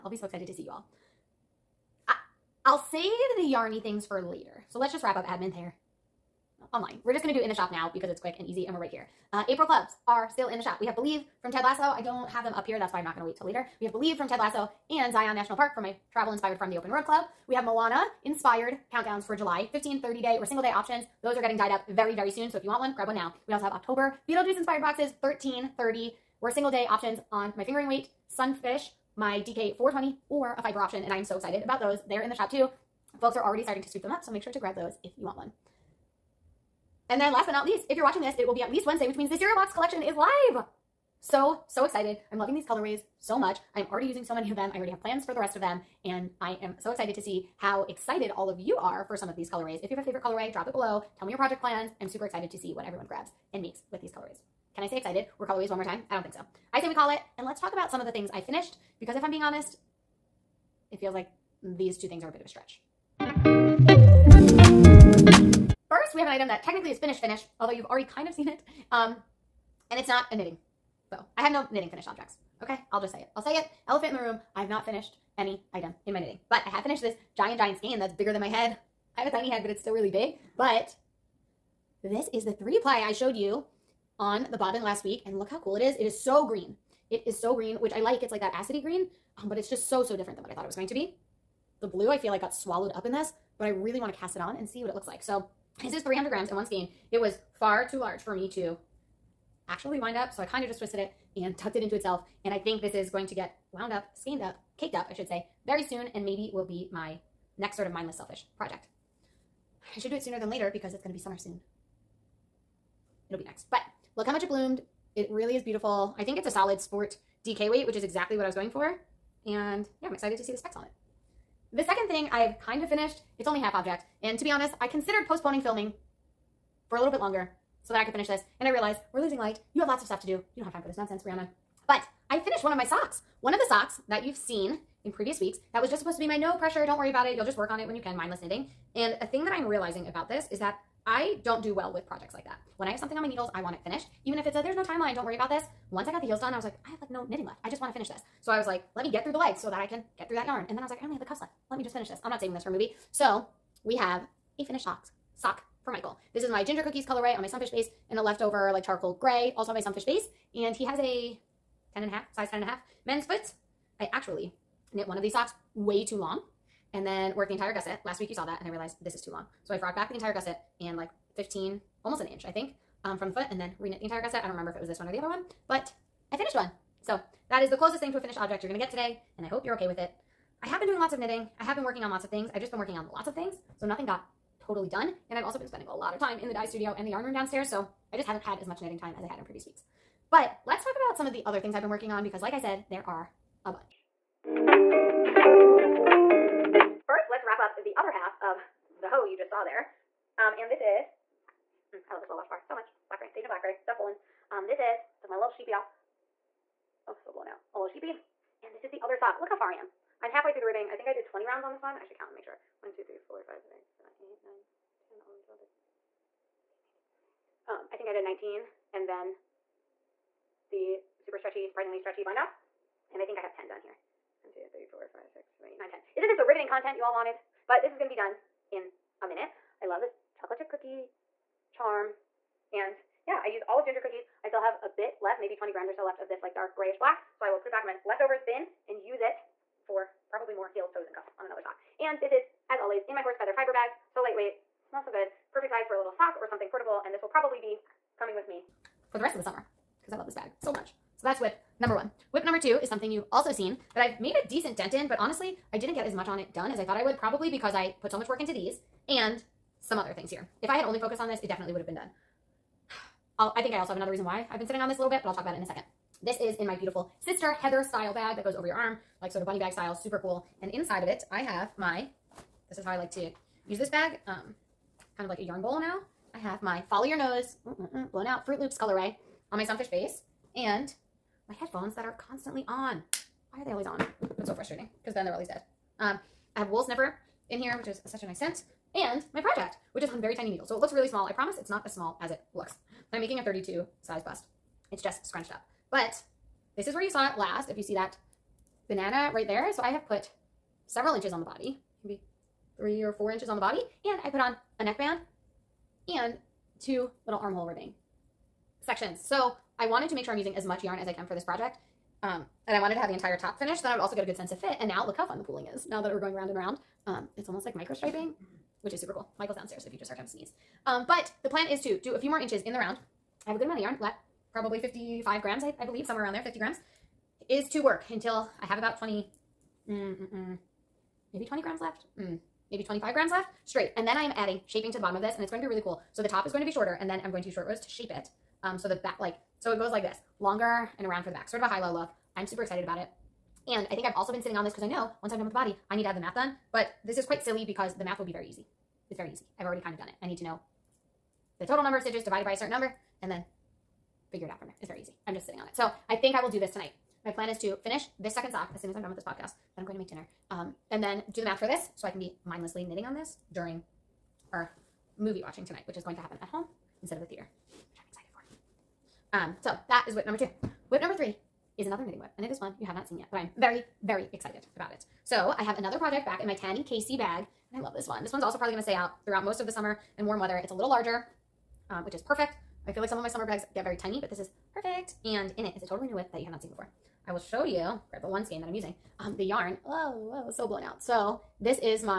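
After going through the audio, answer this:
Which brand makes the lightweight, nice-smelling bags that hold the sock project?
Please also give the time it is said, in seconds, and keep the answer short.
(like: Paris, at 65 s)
Horse Feather Fiber, at 243 s.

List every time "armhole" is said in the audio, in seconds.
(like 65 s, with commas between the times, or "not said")
307 s.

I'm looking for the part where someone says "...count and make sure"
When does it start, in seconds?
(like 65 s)
212 s.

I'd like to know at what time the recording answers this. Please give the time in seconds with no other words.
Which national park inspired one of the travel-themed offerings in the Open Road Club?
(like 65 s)
15 s.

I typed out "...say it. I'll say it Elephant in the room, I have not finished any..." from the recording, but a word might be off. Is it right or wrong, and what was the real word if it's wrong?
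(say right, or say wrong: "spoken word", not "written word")
right.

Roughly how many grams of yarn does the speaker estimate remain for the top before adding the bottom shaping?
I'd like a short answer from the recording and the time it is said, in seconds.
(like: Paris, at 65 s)
55 grams, at 324 s.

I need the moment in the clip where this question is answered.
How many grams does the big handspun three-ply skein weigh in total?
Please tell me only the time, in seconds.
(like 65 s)
96 s.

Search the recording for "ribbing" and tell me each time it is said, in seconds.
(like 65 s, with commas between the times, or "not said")
210 s, 307 s.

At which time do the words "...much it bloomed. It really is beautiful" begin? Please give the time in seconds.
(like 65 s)
114 s.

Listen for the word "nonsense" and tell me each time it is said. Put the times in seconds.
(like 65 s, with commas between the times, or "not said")
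130 s.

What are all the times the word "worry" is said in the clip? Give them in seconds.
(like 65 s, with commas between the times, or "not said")
136 s, 145 s.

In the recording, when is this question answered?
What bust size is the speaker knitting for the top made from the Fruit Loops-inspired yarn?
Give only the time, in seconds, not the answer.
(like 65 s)
293 s.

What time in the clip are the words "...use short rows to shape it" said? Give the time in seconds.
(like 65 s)
337 s.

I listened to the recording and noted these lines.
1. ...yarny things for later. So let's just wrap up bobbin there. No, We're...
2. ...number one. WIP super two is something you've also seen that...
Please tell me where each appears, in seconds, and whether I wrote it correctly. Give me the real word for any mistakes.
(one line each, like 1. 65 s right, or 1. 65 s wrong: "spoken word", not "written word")
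1. 3 s wrong: "admin", not "bobbin"
2. 251 s wrong: "number", not "super".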